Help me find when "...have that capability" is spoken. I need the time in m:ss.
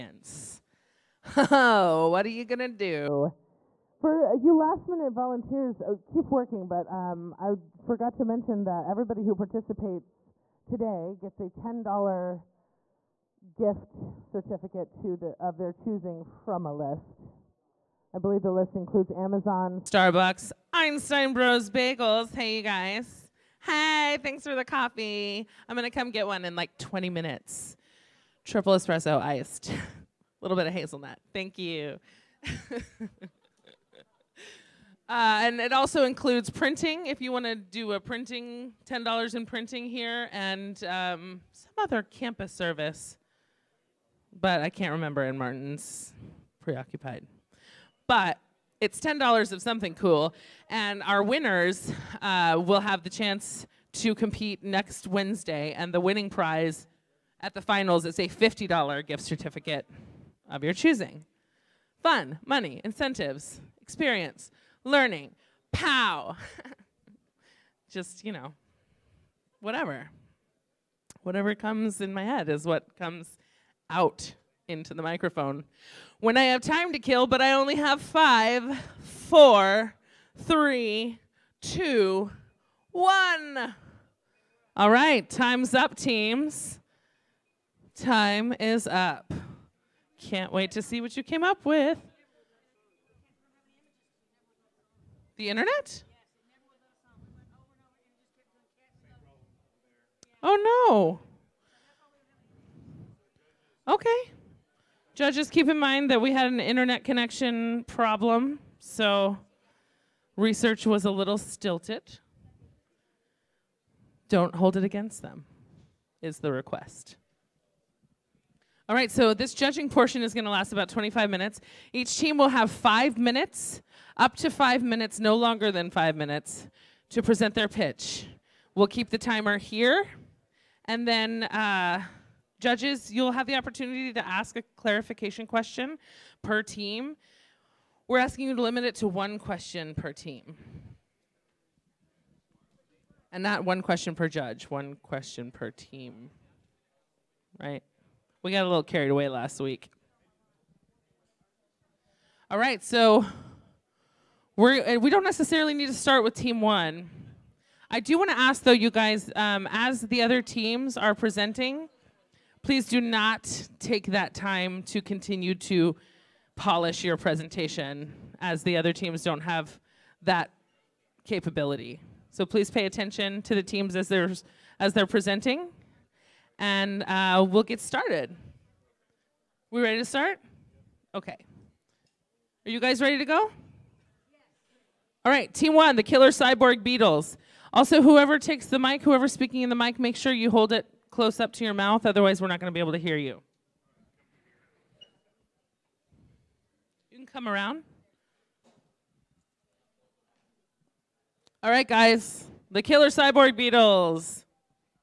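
2:49.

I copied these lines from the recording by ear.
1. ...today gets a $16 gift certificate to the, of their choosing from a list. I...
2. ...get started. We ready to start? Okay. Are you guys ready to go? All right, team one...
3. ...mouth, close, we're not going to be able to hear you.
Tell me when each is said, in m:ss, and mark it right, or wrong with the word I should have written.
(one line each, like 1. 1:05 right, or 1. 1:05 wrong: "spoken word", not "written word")
1. 0:10 wrong: "10", not "16"
2. 2:57 right
3. 3:11 wrong: "otherwise", not "close".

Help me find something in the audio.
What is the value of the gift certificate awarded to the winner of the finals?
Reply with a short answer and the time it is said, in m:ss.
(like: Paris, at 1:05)
$50, at 0:58.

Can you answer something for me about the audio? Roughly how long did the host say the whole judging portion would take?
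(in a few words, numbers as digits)
25 minutes.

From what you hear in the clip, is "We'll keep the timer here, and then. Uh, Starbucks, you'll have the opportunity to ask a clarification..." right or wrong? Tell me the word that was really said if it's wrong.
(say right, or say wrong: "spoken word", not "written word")
wrong: "Judges", not "Starbucks".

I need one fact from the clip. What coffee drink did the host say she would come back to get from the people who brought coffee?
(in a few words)
Triple espresso iced.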